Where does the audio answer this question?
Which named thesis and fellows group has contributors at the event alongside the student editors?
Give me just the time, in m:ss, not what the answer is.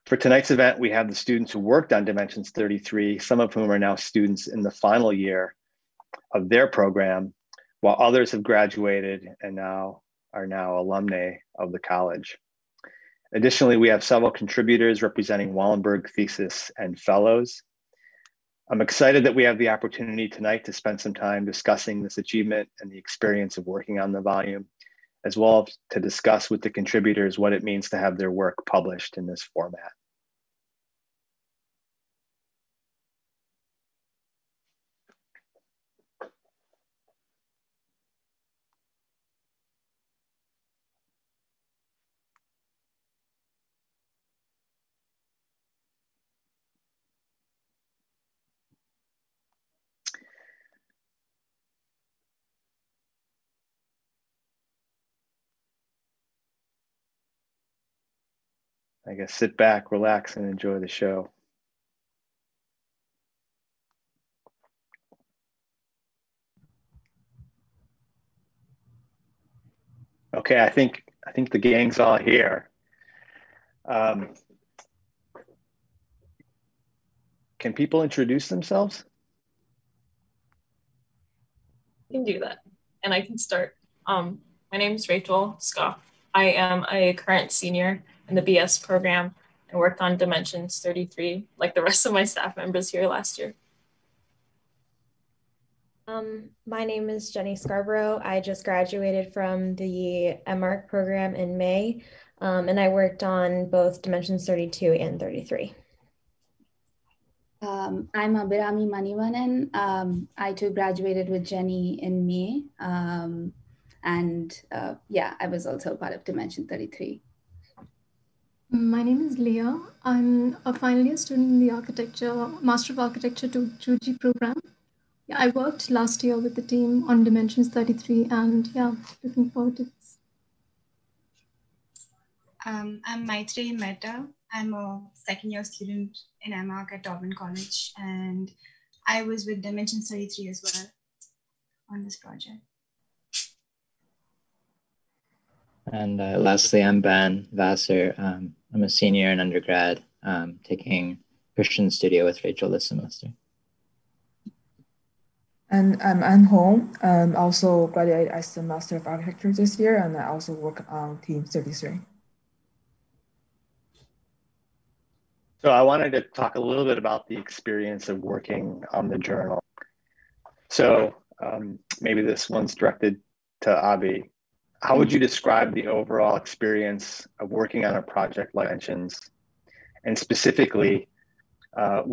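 0:15.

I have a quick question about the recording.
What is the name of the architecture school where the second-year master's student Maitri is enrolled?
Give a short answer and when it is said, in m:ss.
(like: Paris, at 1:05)
Taubman College, at 2:17.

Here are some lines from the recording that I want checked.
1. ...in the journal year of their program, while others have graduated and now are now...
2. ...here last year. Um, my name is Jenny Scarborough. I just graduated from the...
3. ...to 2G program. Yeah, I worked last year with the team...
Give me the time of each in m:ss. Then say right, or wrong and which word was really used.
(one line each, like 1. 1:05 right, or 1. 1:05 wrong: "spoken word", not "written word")
1. 0:04 wrong: "final", not "journal"
2. 1:32 right
3. 2:03 right.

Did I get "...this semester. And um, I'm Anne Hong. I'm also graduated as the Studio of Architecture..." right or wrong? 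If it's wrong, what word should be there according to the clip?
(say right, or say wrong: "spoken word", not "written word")
wrong: "Master", not "Studio".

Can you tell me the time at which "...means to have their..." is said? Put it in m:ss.
0:27.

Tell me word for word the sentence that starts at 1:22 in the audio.
You can do that, and I can start.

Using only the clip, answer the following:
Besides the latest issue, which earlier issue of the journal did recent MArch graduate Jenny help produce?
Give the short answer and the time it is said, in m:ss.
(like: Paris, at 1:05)
Dimensions 32, at 1:44.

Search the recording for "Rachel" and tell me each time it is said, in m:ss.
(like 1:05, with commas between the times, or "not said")
1:25, 2:32.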